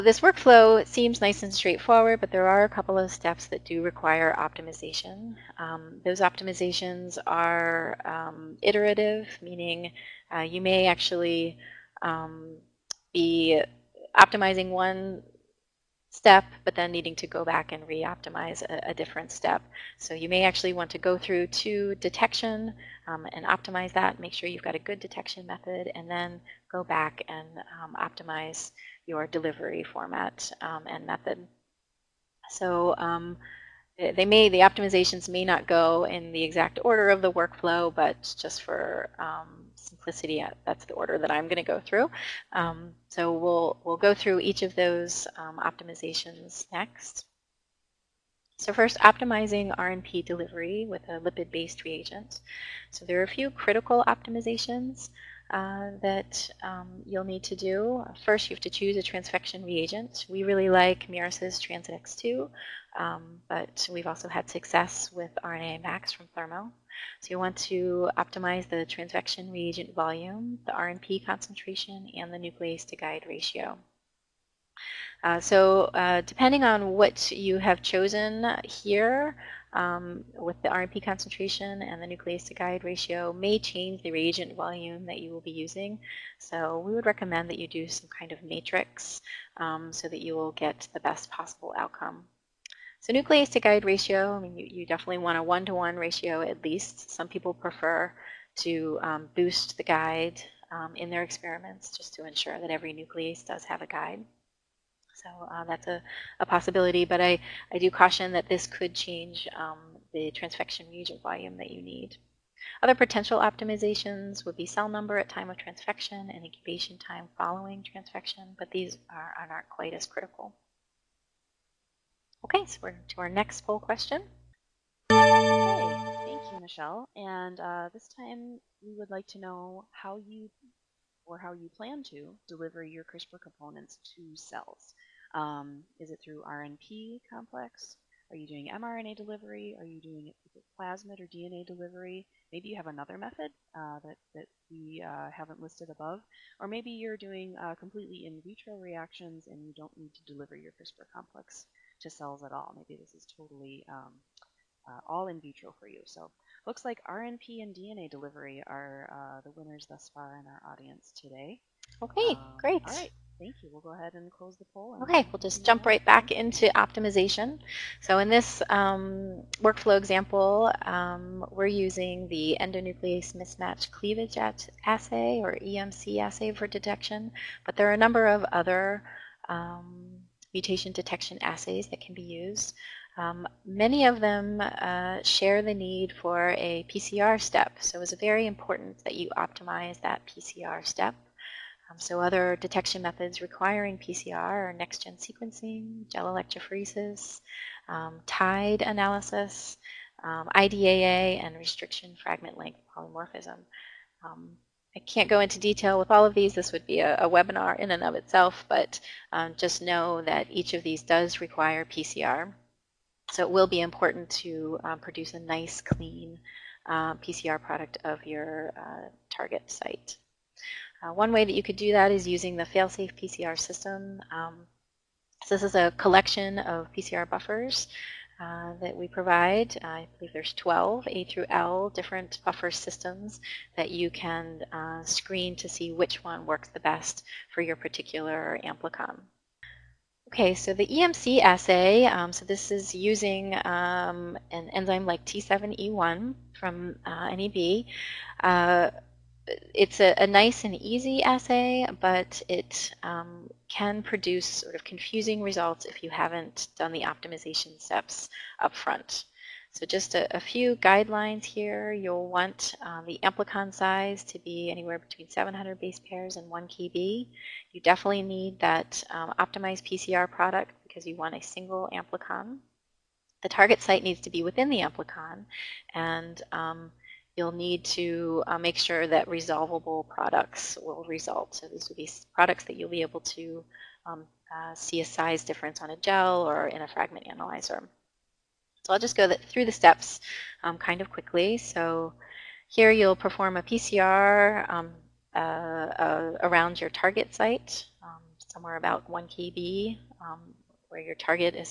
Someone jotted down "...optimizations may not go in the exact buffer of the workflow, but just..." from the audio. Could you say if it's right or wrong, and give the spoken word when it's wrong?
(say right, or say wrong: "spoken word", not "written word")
wrong: "order", not "buffer".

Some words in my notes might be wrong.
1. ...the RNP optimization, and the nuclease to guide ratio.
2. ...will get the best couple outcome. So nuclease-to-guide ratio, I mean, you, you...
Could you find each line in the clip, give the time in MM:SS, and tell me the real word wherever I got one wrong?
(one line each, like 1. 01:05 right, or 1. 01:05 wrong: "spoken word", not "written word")
1. 01:10 wrong: "concentration", not "optimization"
2. 01:30 wrong: "possible", not "couple".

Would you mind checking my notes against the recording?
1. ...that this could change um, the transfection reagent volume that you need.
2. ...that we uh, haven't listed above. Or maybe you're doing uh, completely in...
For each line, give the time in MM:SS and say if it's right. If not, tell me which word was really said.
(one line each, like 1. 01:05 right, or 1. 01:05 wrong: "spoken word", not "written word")
1. 01:48 right
2. 02:24 right.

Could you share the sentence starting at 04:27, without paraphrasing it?
You definitely need that um, optimized PCR product because you want a single amplicon.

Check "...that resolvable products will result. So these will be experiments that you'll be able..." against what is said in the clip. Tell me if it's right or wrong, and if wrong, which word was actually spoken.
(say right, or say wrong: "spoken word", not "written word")
wrong: "products", not "experiments".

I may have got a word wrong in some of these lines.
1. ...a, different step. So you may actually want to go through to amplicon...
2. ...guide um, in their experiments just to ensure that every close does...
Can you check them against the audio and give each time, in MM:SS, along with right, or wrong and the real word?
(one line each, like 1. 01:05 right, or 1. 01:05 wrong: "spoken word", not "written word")
1. 00:18 wrong: "detection", not "amplicon"
2. 01:39 wrong: "nuclease", not "close".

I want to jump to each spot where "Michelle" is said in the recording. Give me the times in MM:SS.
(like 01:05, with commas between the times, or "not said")
02:06.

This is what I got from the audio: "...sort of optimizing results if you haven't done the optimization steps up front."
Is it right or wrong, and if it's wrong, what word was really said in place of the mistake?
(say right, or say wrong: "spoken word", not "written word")
wrong: "confusing", not "optimizing".